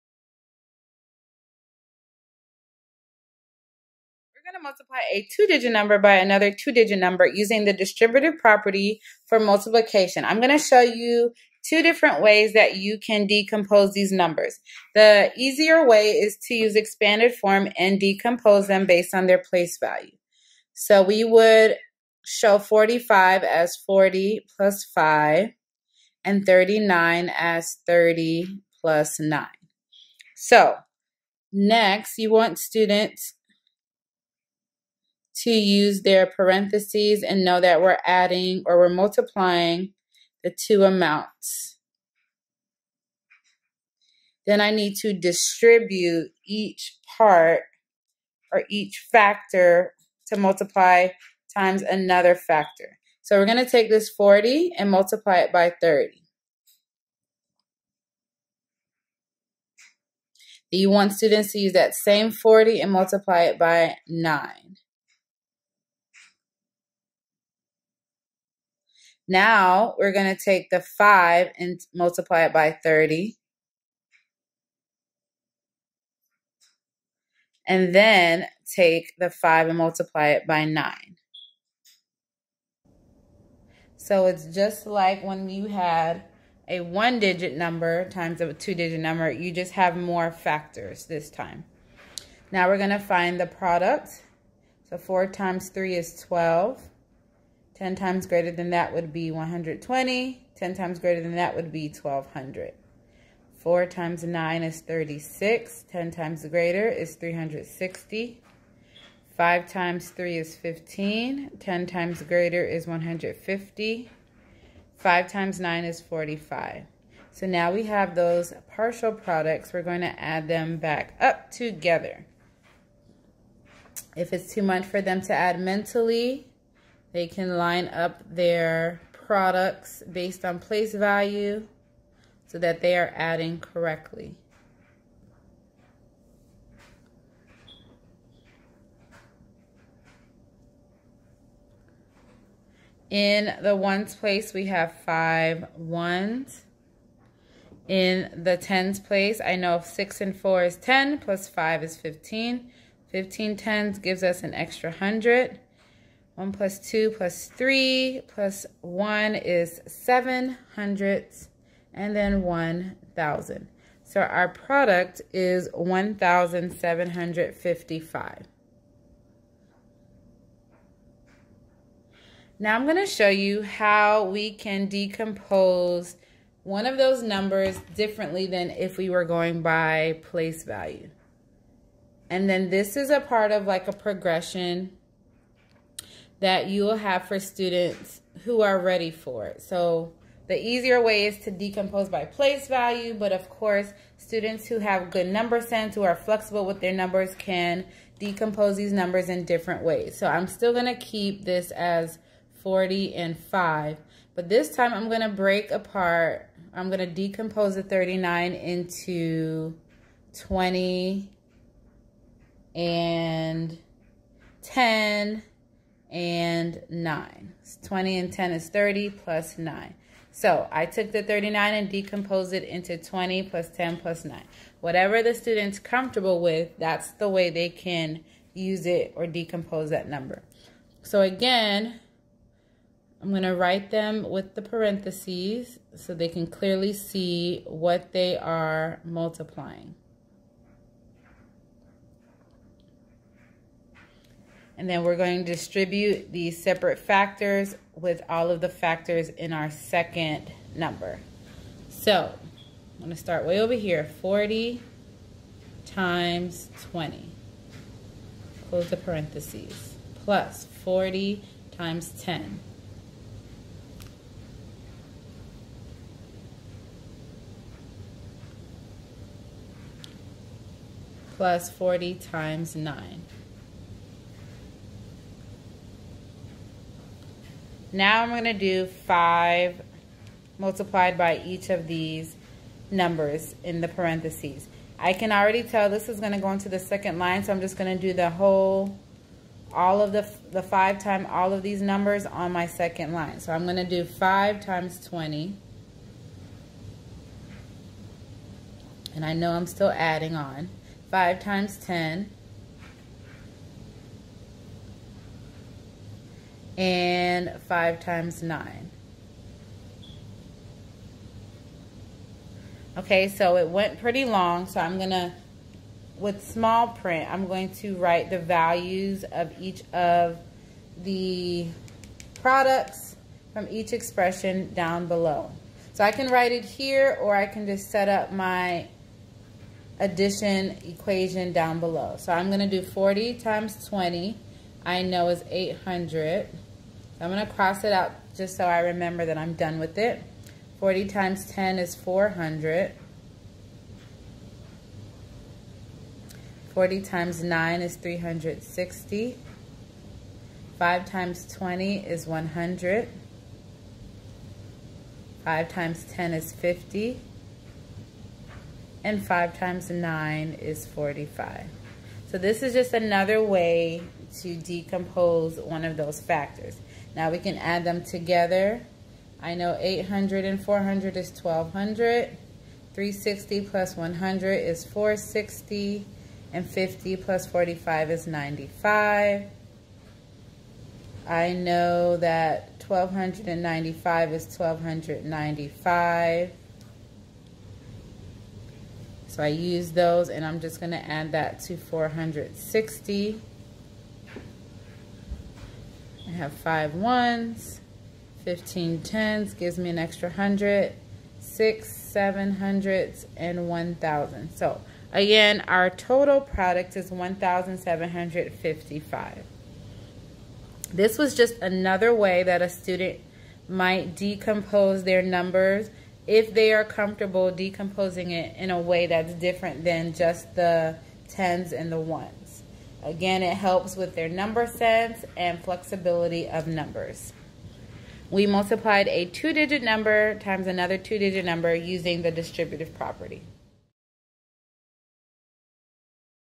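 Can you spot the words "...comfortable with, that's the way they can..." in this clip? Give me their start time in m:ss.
3:45.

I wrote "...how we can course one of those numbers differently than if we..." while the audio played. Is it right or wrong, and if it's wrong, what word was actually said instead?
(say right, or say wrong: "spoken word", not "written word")
wrong: "decompose", not "course".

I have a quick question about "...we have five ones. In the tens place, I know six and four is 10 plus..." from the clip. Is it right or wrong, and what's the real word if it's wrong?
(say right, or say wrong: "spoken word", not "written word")
right.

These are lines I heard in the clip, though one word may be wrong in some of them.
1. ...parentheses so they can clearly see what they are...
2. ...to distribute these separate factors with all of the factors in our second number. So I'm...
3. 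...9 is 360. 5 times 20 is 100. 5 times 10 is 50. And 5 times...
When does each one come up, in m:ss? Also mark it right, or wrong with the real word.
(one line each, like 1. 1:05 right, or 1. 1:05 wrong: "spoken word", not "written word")
1. 3:54 right
2. 4:05 right
3. 5:47 right.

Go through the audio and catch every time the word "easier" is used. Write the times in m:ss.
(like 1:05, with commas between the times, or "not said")
0:15, 3:10.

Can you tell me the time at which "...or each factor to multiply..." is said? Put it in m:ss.
0:48.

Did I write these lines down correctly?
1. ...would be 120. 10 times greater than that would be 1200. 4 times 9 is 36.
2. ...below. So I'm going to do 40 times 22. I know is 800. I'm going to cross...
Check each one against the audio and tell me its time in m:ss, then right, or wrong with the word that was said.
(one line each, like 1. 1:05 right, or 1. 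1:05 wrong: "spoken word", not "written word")
1. 1:38 right
2. 5:31 wrong: "20", not "22".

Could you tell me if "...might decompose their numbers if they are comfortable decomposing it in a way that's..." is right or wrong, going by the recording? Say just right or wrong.
right.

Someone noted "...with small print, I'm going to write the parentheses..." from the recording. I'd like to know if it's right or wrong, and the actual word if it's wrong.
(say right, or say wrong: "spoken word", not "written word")
wrong: "values", not "parentheses".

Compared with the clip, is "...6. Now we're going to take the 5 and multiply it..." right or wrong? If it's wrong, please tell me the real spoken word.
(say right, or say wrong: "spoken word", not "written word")
wrong: "9", not "6".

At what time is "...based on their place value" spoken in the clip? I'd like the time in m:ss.
0:18.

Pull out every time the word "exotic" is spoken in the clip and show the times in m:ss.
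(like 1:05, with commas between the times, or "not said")
not said.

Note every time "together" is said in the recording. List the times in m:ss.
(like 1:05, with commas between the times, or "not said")
2:01.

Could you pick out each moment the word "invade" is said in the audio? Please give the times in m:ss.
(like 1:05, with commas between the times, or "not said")
not said.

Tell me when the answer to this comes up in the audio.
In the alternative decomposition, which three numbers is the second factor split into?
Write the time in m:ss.
3:30.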